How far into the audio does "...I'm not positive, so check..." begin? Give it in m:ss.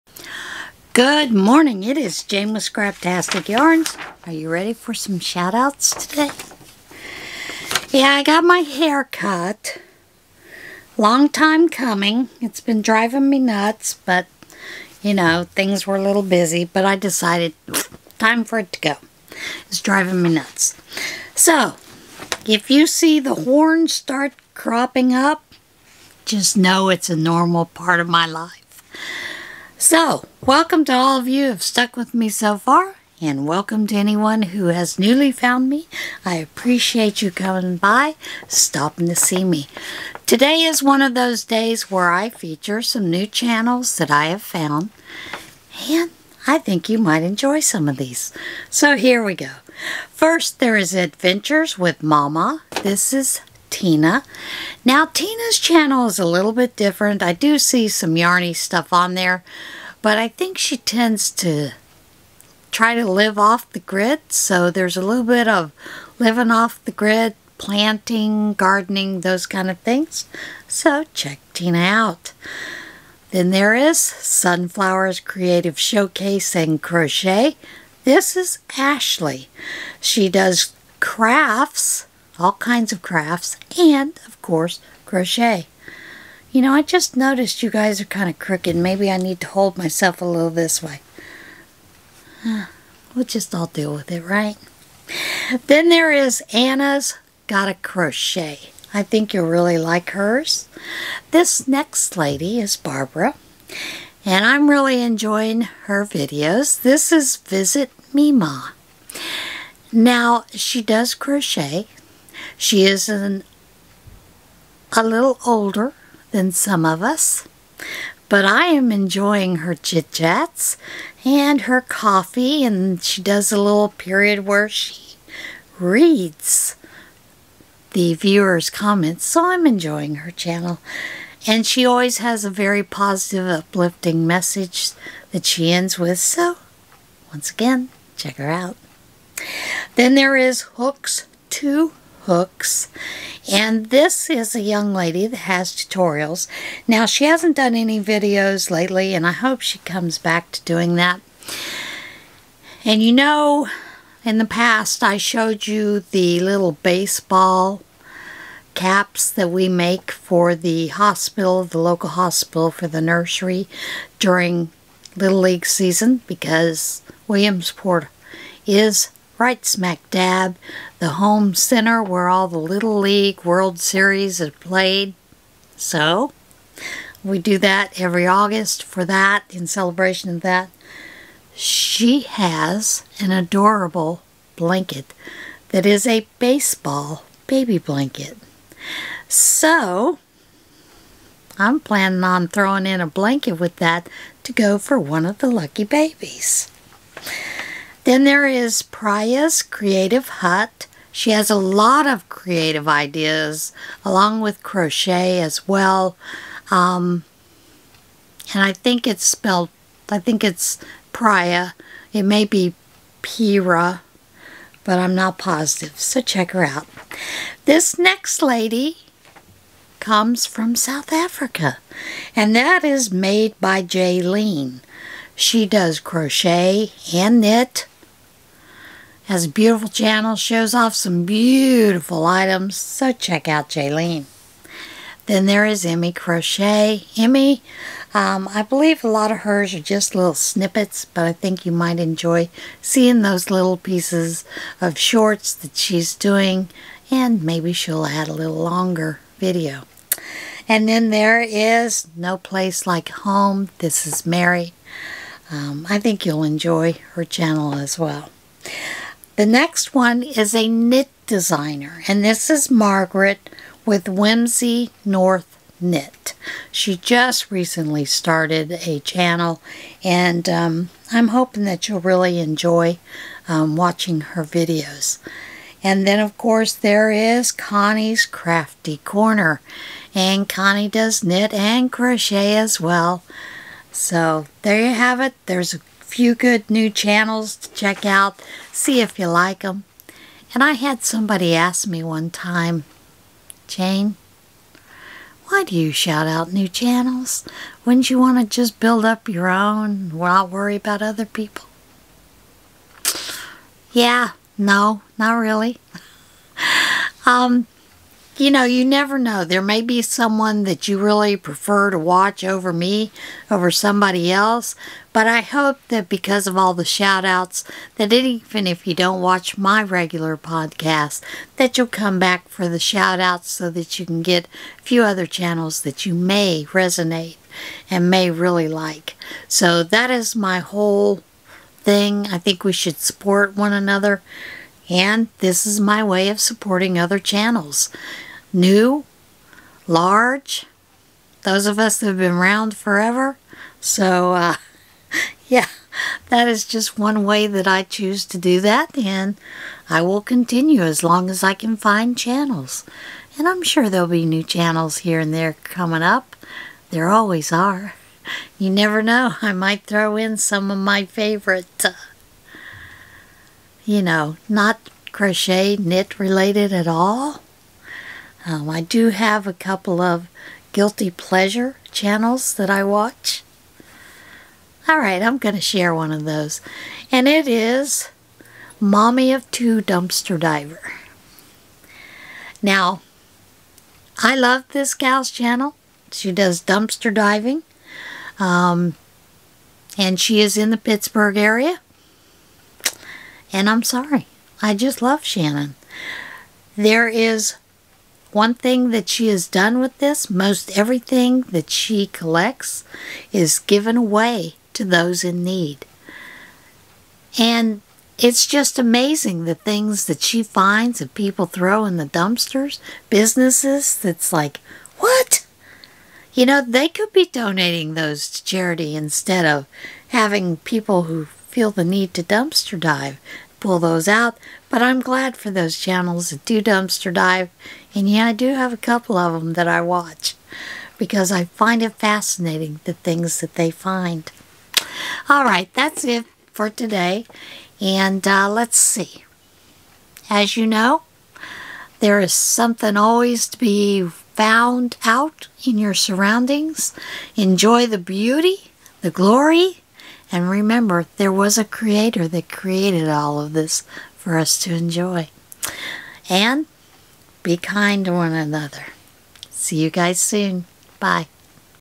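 3:34.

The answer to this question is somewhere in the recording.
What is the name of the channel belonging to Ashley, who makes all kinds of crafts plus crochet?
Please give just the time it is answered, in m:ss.
1:13.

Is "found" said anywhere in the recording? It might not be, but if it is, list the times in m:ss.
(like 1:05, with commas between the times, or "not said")
0:35, 0:44, 7:24.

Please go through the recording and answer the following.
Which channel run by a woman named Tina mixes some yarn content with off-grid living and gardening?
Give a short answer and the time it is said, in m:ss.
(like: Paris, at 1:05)
Adventures with MawMaw, at 0:50.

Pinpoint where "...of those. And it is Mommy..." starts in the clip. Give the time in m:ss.
6:16.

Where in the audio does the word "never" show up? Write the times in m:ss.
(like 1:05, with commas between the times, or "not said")
5:08, 5:58.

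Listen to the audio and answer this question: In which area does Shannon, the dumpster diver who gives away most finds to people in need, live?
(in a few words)
Pittsburgh.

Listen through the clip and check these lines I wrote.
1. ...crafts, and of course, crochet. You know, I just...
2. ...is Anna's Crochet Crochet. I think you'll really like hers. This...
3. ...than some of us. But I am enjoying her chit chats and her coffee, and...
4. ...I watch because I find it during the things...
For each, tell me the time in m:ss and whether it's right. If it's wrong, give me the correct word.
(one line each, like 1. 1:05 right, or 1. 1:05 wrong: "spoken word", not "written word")
1. 1:23 right
2. 1:36 wrong: "Gotta", not "Crochet"
3. 1:56 right
4. 7:09 wrong: "fascinating", not "during".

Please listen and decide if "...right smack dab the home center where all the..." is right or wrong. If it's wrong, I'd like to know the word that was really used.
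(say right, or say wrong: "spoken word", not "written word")
right.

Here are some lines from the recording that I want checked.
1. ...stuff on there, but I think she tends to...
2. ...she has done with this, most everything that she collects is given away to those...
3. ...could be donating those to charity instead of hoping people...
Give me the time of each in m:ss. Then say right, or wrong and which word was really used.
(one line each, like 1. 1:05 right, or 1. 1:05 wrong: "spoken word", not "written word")
1. 0:58 right
2. 6:39 right
3. 6:56 wrong: "having", not "hoping".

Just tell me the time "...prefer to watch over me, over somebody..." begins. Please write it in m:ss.
5:11.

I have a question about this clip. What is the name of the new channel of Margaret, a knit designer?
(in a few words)
Whimsy North Knit.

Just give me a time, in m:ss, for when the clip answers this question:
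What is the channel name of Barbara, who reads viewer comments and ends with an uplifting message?
1:47.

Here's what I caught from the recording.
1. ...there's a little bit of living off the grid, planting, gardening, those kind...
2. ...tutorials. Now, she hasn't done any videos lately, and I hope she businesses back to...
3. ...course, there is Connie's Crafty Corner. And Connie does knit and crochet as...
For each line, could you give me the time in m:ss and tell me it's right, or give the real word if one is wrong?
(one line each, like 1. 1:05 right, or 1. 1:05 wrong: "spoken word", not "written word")
1. 1:04 right
2. 2:25 wrong: "comes", not "businesses"
3. 4:36 right.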